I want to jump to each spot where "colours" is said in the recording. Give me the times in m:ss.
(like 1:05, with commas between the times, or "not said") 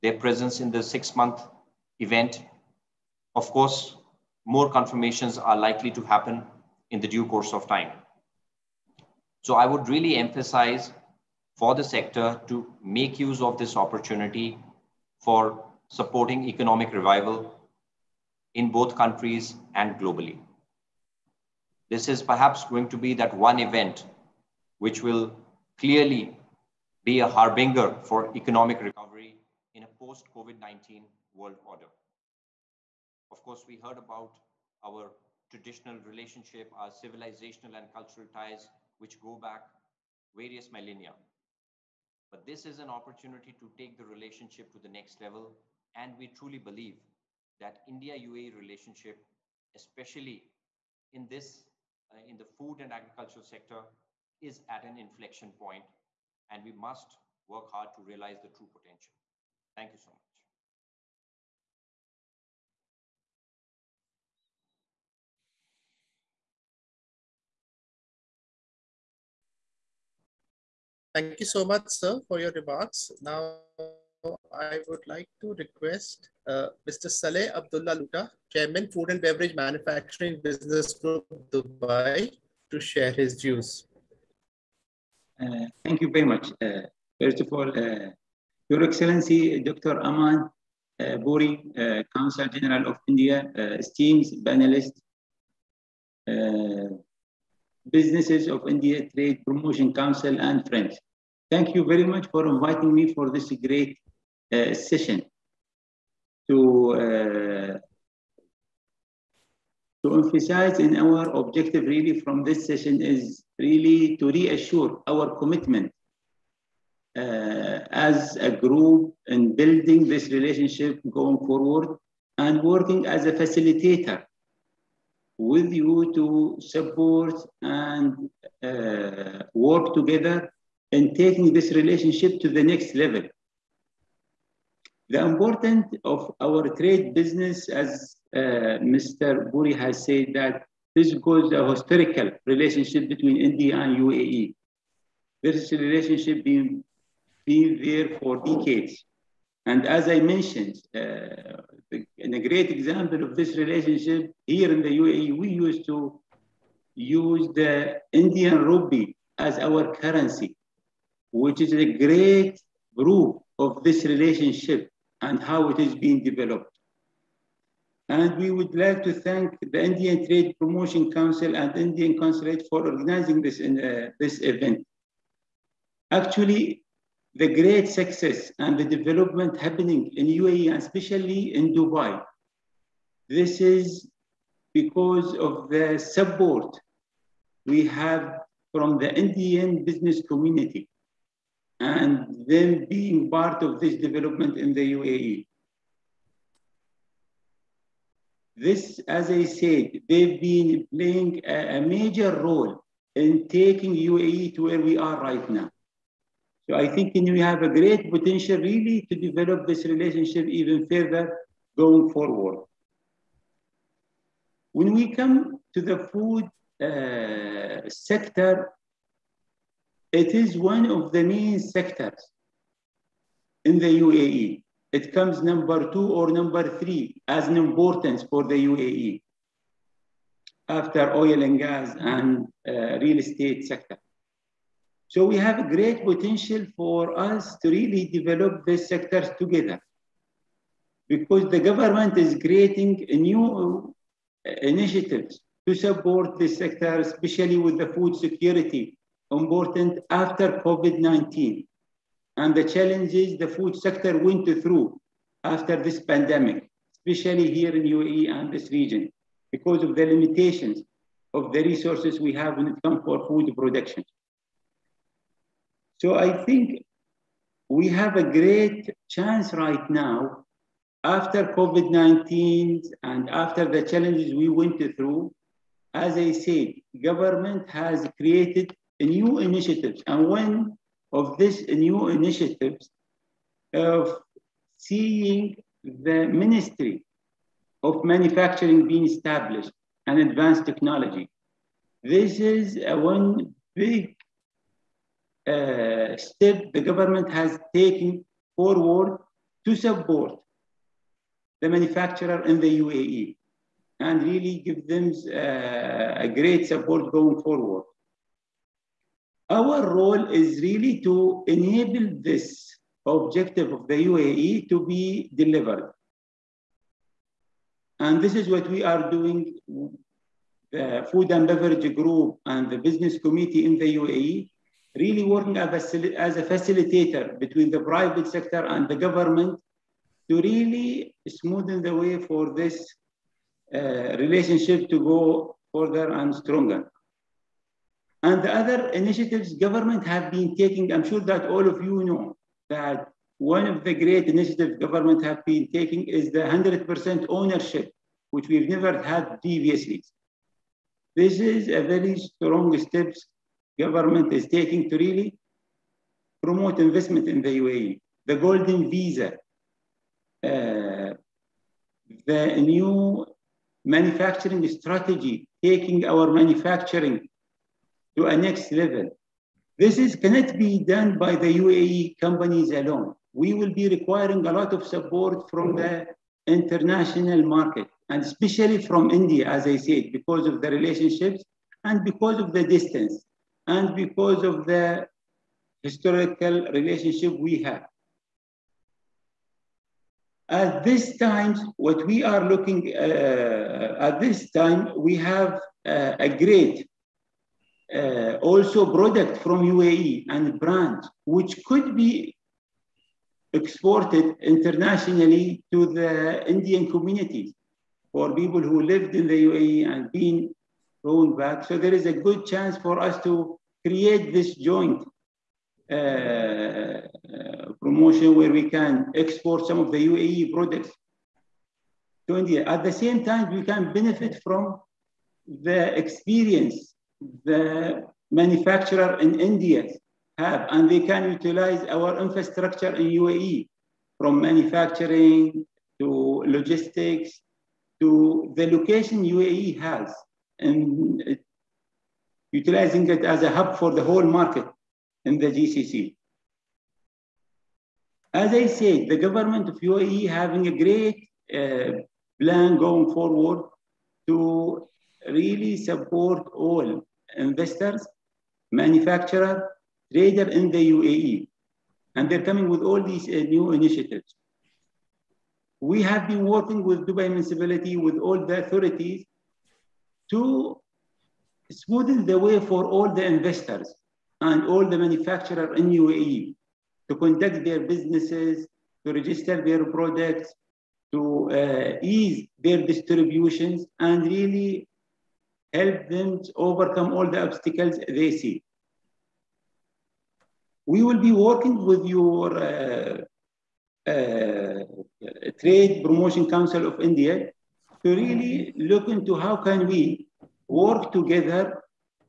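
not said.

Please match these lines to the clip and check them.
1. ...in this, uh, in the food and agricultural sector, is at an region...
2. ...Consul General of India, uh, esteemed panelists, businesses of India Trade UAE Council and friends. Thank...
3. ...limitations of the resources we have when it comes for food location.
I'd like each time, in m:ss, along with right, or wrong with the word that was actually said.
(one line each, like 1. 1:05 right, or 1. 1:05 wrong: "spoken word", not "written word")
1. 0:51 wrong: "inflection", not "region"
2. 1:32 wrong: "Promotion", not "UAE"
3. 4:20 wrong: "production", not "location".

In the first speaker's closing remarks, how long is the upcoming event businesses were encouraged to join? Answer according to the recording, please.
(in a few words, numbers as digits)
six month.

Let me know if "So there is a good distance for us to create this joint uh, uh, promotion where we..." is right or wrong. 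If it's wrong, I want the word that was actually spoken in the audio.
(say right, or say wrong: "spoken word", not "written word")
wrong: "chance", not "distance".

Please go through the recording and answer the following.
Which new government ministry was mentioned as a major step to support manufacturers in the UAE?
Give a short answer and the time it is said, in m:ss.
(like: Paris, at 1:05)
Ministry of Manufacturing, at 4:46.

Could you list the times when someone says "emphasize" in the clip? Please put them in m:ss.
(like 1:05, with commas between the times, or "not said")
0:10, 1:50.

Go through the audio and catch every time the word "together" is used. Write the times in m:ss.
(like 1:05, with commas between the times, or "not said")
2:09, 3:59, 8:21.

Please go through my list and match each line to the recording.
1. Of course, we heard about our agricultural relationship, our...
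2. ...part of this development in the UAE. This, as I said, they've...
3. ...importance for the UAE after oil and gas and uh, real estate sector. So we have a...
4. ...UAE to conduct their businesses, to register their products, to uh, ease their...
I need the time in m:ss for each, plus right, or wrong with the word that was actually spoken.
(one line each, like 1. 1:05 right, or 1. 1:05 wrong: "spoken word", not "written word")
1. 0:33 wrong: "traditional", not "agricultural"
2. 3:13 right
3. 3:47 right
4. 7:55 right.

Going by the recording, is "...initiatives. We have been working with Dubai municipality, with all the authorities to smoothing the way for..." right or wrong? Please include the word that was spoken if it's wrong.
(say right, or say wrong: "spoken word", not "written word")
right.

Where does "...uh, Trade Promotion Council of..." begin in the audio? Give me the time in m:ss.
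8:14.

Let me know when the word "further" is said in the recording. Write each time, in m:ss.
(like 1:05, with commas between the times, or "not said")
3:30, 5:35.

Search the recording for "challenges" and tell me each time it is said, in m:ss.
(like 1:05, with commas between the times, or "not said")
4:12, 4:33.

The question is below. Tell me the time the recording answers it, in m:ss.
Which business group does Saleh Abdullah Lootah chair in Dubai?
1:18.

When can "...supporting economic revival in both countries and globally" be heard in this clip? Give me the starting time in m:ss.
0:15.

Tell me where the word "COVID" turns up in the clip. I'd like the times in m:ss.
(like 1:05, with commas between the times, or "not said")
0:30, 4:10, 4:31.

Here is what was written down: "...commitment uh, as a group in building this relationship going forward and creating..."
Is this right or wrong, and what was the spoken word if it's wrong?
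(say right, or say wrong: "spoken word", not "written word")
wrong: "working", not "creating".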